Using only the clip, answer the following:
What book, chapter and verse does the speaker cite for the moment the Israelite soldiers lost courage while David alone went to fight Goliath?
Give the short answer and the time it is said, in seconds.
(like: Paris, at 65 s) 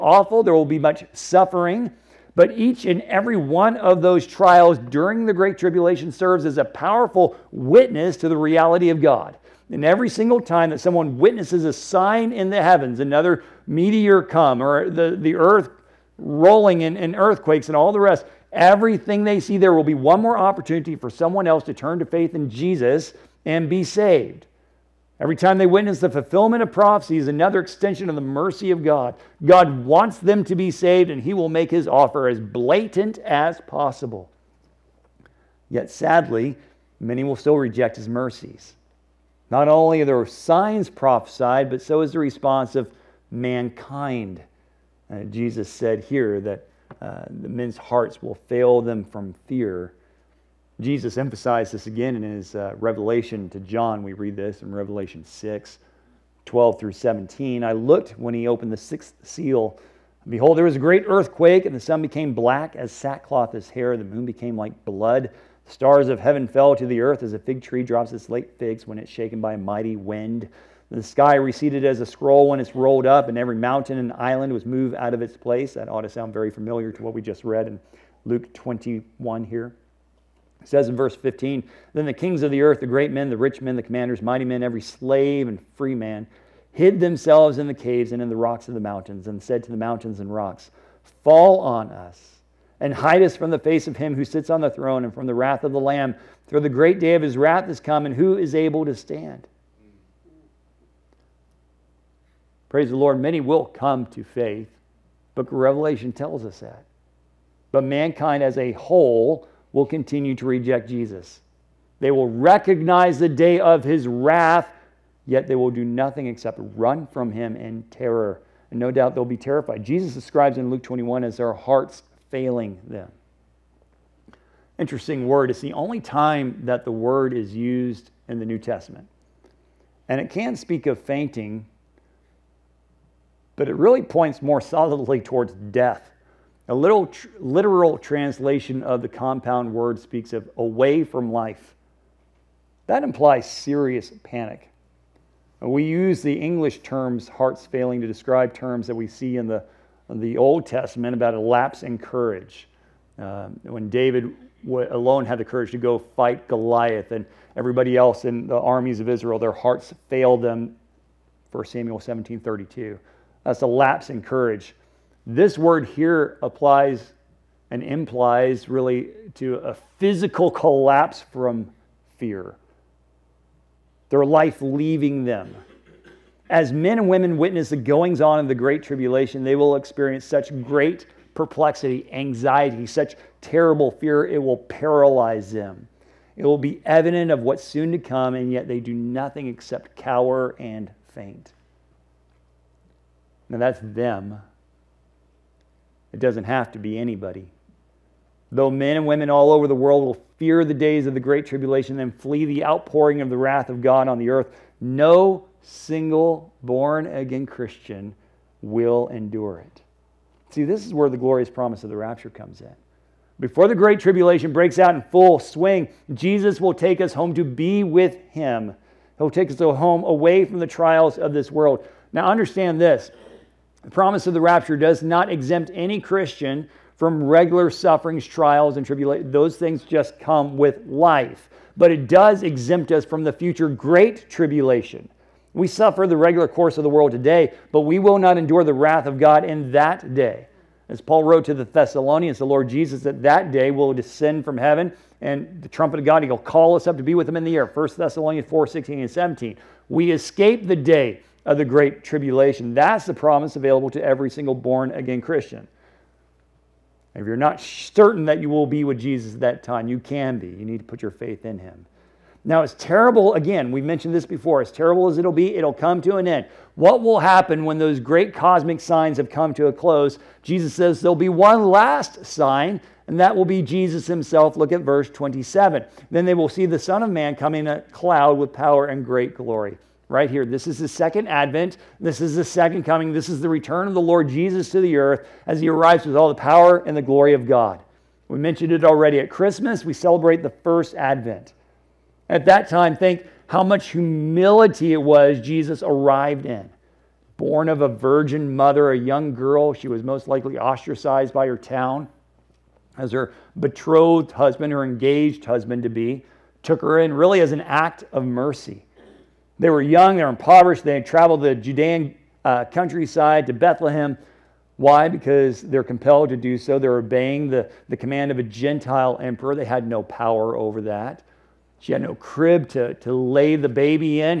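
1 Samuel 17:32, at 161 s.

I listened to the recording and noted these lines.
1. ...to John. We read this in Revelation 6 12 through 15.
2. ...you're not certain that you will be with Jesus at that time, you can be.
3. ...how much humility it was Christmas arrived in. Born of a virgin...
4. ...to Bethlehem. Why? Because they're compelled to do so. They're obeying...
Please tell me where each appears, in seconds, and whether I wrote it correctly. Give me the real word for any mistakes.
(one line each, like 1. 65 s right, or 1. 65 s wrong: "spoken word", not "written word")
1. 53 s wrong: "17", not "15"
2. 257 s right
3. 293 s wrong: "Jesus", not "Christmas"
4. 313 s right.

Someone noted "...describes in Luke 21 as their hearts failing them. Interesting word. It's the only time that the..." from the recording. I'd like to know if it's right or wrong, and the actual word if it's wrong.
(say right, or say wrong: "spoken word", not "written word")
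right.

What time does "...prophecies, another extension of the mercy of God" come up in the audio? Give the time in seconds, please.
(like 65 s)
26 s.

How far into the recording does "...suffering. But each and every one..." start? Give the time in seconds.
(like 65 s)
1 s.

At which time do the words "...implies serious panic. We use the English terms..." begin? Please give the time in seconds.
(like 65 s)
143 s.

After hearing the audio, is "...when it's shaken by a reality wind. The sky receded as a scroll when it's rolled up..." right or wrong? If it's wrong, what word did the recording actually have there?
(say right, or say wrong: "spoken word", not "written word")
wrong: "mighty", not "reality".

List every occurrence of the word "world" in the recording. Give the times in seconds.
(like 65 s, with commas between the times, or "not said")
199 s, 221 s, 236 s.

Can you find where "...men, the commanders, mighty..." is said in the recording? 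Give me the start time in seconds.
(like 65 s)
83 s.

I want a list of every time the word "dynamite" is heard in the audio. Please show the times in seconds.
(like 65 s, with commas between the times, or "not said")
not said.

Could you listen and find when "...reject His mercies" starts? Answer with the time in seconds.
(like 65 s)
37 s.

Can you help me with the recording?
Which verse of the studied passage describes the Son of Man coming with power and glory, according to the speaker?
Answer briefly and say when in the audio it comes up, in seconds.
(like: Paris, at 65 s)
Verse 27, at 274 s.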